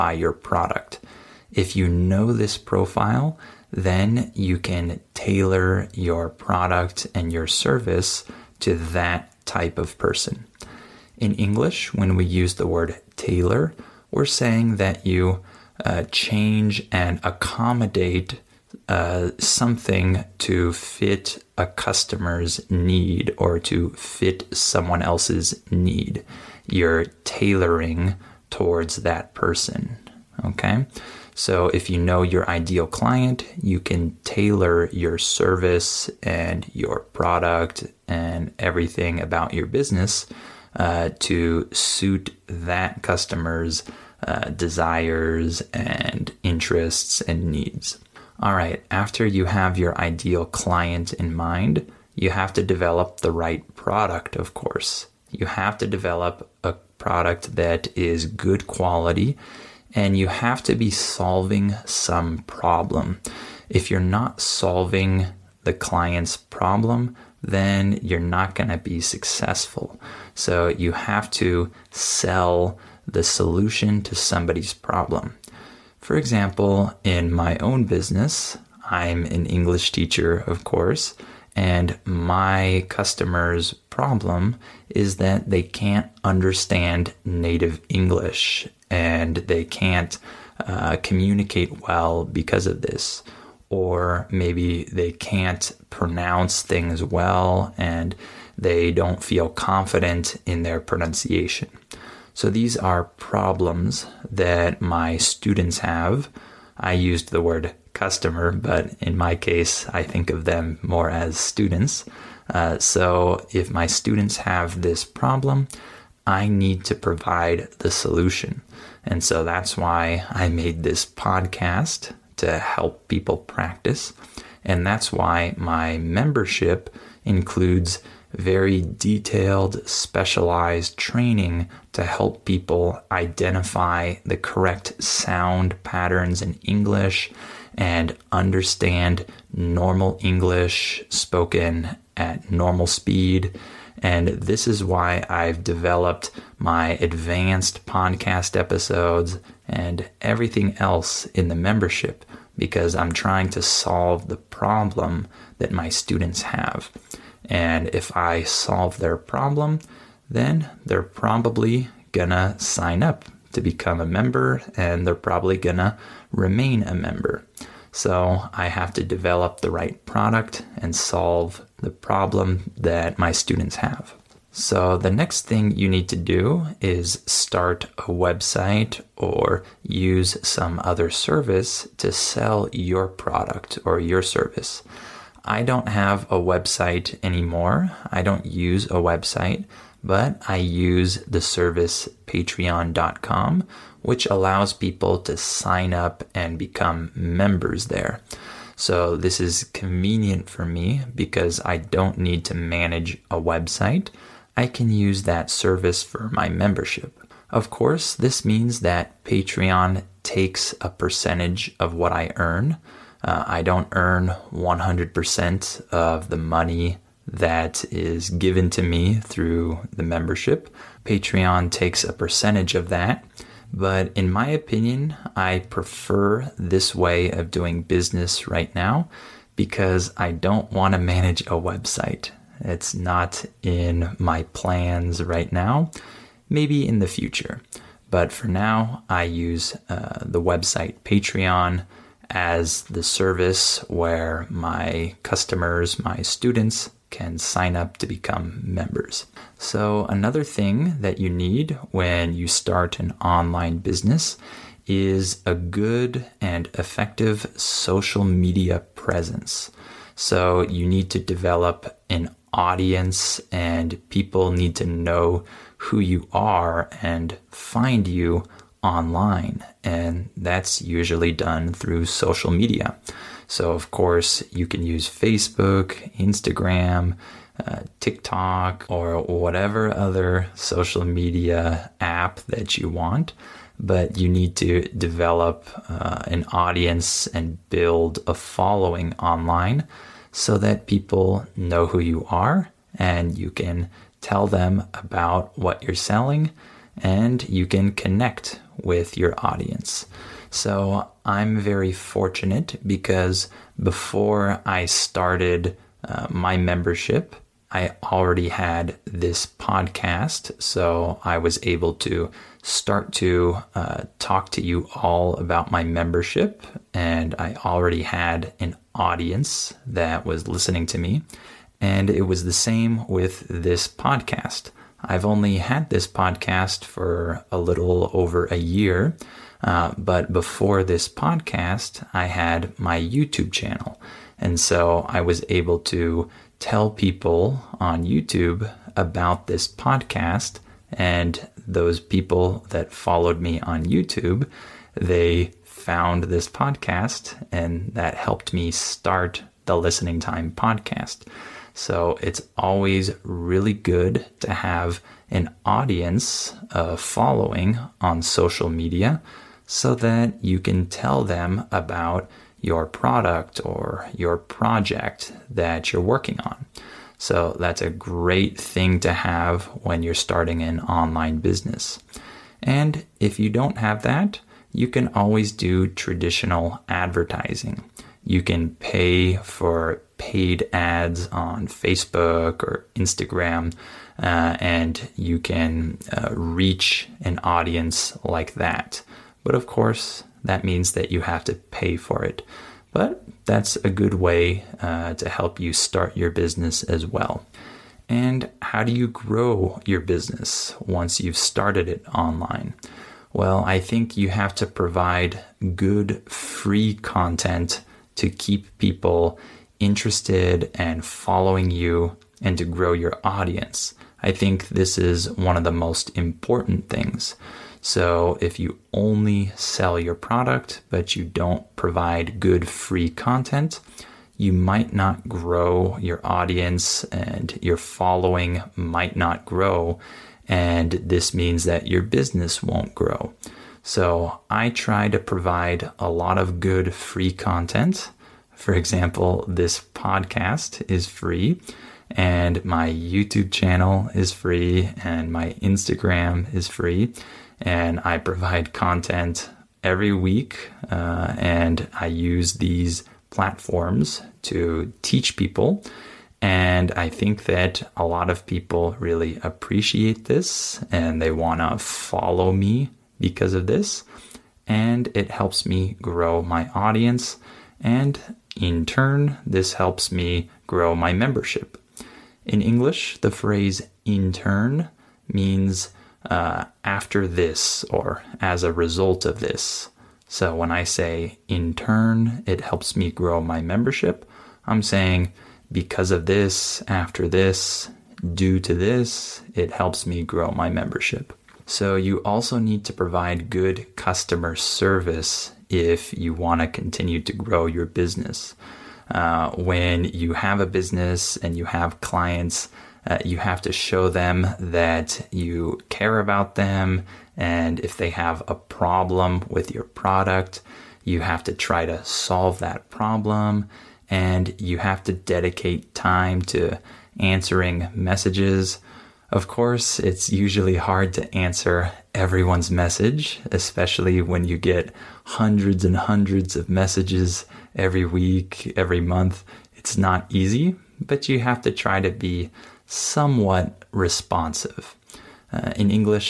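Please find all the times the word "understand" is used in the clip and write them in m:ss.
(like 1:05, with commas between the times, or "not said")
1:26, 2:18.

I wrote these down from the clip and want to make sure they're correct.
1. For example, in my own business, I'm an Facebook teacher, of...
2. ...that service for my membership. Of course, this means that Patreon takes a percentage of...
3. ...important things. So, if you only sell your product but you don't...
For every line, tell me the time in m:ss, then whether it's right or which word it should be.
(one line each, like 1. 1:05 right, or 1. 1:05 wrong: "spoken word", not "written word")
1. 1:15 wrong: "English", not "Facebook"
2. 3:25 right
3. 6:56 right.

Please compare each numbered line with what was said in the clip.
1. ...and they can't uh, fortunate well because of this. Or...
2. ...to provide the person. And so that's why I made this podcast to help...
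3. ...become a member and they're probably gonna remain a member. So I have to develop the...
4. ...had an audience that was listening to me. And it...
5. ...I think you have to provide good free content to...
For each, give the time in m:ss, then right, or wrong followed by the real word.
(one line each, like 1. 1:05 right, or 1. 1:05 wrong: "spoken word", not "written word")
1. 1:28 wrong: "communicate", not "fortunate"
2. 1:56 wrong: "solution", not "person"
3. 2:43 right
4. 5:18 right
5. 6:43 right.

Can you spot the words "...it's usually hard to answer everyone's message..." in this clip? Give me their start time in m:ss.
8:39.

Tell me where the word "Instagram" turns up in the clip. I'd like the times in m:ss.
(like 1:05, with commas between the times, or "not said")
4:36, 6:22, 7:25.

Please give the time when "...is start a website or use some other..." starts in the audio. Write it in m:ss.
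2:56.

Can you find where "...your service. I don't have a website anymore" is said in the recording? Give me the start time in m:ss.
3:03.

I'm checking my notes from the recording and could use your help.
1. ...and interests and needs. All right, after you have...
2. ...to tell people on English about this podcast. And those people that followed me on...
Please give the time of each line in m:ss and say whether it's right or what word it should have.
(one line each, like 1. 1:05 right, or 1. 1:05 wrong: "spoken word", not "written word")
1. 0:45 right
2. 5:35 wrong: "YouTube", not "English".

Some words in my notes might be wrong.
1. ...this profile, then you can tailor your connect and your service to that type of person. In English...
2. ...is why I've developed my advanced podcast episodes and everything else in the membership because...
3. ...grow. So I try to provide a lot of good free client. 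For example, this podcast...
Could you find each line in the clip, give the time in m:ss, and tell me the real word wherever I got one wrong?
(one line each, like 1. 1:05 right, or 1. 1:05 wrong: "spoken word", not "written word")
1. 0:02 wrong: "product", not "connect"
2. 2:24 right
3. 7:12 wrong: "content", not "client".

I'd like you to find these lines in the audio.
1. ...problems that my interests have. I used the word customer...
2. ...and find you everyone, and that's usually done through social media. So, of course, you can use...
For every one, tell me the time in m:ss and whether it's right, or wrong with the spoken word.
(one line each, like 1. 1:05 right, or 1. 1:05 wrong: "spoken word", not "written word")
1. 1:43 wrong: "students", not "interests"
2. 4:27 wrong: "online", not "everyone".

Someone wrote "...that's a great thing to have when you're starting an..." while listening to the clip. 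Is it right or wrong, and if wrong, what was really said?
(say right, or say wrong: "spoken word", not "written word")
right.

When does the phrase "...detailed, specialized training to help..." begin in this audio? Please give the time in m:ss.
2:08.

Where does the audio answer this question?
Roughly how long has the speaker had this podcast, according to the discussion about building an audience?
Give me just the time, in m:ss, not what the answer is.
5:27.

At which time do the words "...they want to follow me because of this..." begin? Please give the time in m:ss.
7:41.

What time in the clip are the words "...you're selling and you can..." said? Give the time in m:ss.
4:55.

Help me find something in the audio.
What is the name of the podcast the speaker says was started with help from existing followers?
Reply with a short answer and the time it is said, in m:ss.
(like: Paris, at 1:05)
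Listening Time, at 5:49.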